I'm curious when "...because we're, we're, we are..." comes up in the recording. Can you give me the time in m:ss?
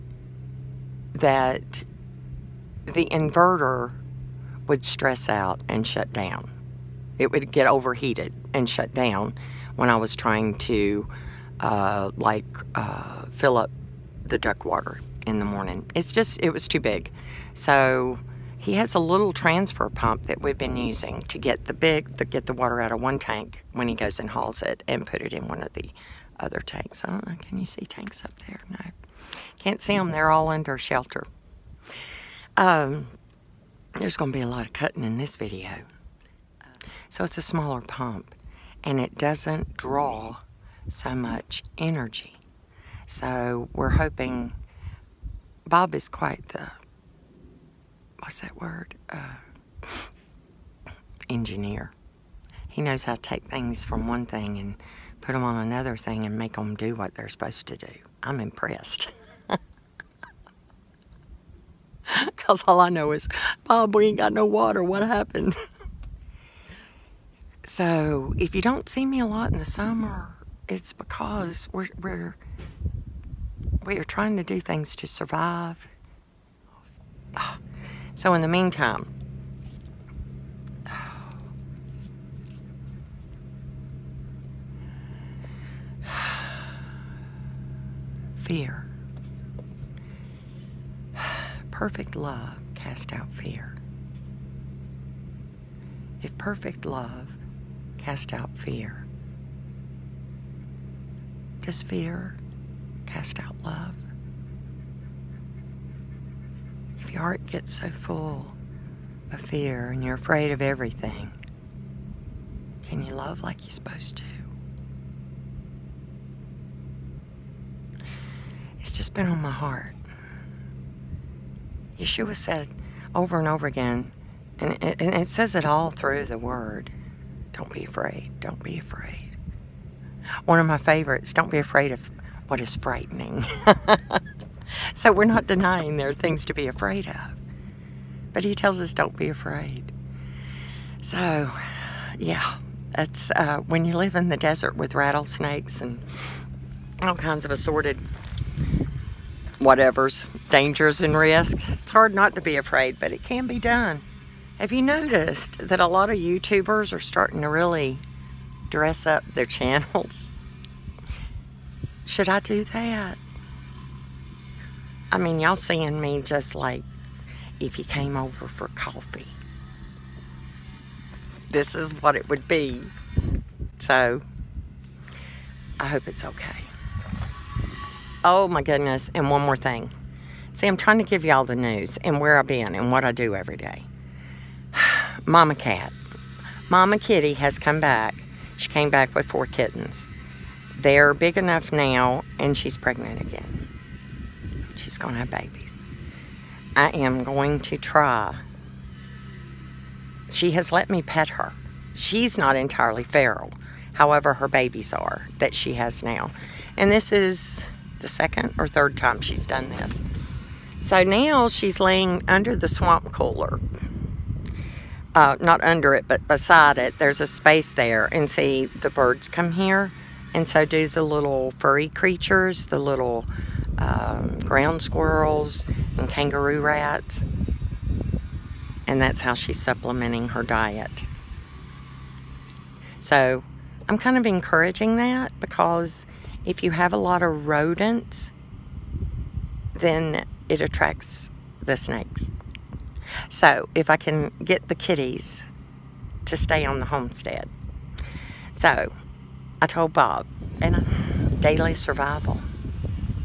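1:10.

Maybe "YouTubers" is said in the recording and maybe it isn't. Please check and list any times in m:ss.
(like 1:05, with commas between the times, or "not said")
2:36.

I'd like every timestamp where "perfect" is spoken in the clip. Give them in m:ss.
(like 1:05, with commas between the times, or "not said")
1:31, 1:36.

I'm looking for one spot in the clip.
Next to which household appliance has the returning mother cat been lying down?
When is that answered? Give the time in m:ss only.
3:32.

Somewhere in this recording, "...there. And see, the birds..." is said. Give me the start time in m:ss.
3:37.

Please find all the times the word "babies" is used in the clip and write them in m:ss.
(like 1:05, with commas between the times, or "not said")
3:15, 3:24.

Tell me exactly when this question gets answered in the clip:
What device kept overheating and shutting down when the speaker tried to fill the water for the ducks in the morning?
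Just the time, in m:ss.
0:02.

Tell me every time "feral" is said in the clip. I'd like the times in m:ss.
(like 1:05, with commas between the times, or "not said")
3:23.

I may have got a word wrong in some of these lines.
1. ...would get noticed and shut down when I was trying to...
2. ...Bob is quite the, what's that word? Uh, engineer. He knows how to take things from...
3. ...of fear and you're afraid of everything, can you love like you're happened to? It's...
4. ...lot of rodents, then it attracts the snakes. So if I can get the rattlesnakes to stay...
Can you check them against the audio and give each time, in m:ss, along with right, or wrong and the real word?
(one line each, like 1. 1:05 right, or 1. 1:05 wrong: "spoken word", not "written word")
1. 0:07 wrong: "overheated", not "noticed"
2. 0:45 right
3. 1:49 wrong: "supposed", not "happened"
4. 3:56 wrong: "kitties", not "rattlesnakes".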